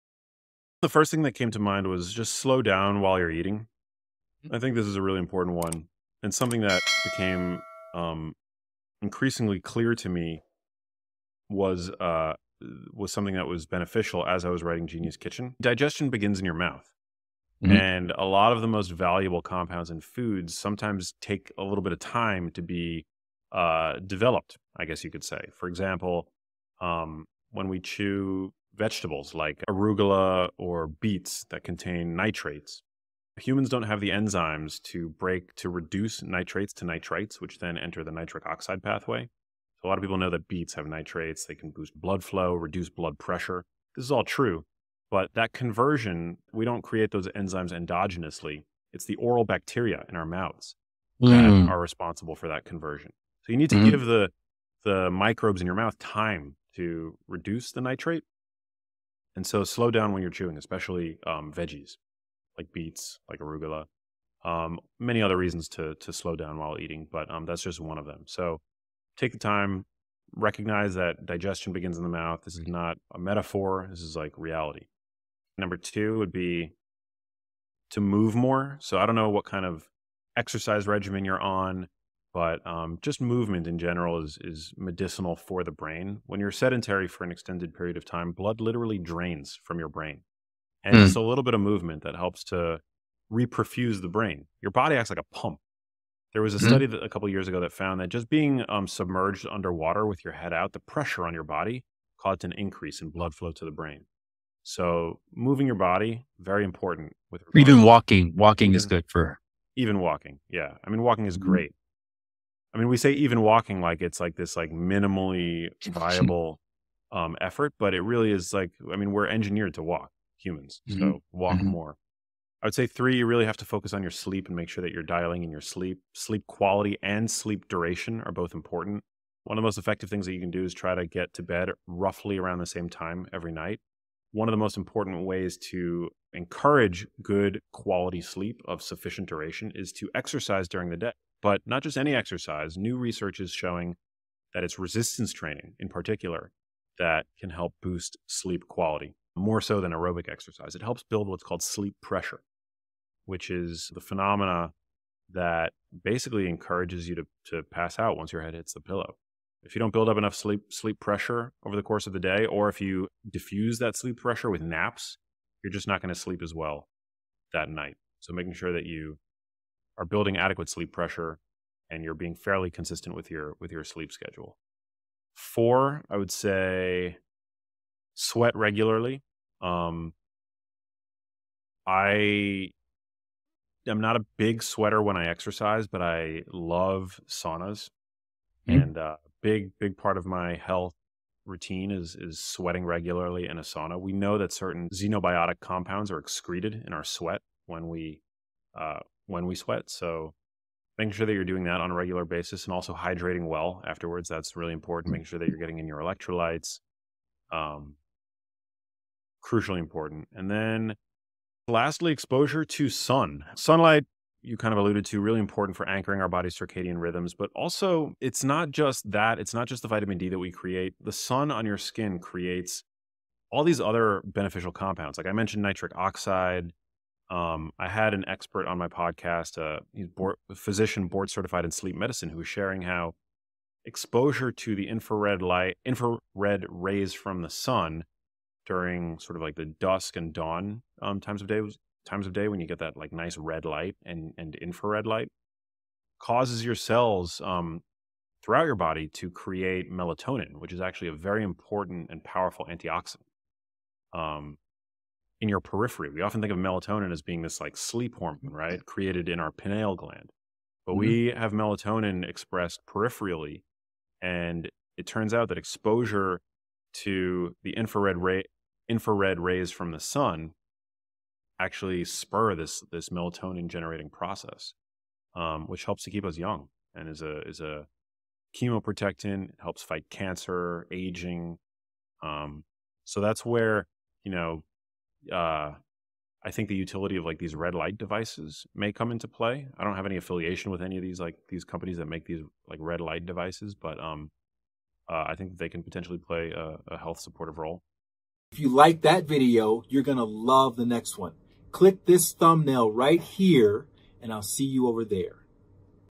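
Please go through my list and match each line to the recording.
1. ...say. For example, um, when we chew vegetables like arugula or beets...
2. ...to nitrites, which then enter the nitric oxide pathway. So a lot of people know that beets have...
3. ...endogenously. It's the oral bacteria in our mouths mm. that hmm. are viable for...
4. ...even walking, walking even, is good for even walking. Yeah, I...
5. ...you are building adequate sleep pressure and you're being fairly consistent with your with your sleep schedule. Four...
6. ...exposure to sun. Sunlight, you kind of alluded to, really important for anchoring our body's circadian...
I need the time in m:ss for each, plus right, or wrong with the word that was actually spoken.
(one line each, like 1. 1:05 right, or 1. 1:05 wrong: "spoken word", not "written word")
1. 0:25 right
2. 0:36 right
3. 0:47 wrong: "responsible", not "viable"
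4. 1:47 right
5. 2:48 right
6. 3:32 right.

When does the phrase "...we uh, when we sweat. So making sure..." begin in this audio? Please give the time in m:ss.
3:17.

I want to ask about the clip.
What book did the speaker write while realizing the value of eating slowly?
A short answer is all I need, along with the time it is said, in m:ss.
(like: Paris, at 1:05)
Genius Kitchen, at 0:14.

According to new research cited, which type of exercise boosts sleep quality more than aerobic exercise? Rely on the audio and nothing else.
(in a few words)
resistance training.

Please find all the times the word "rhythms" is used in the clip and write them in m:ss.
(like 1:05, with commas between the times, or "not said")
3:37.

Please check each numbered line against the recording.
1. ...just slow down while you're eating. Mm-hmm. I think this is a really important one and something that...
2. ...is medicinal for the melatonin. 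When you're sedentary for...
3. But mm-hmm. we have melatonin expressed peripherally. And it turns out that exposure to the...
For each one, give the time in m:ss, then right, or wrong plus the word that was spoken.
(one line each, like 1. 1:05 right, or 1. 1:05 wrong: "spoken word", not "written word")
1. 0:02 right
2. 1:24 wrong: "brain", not "melatonin"
3. 4:20 right.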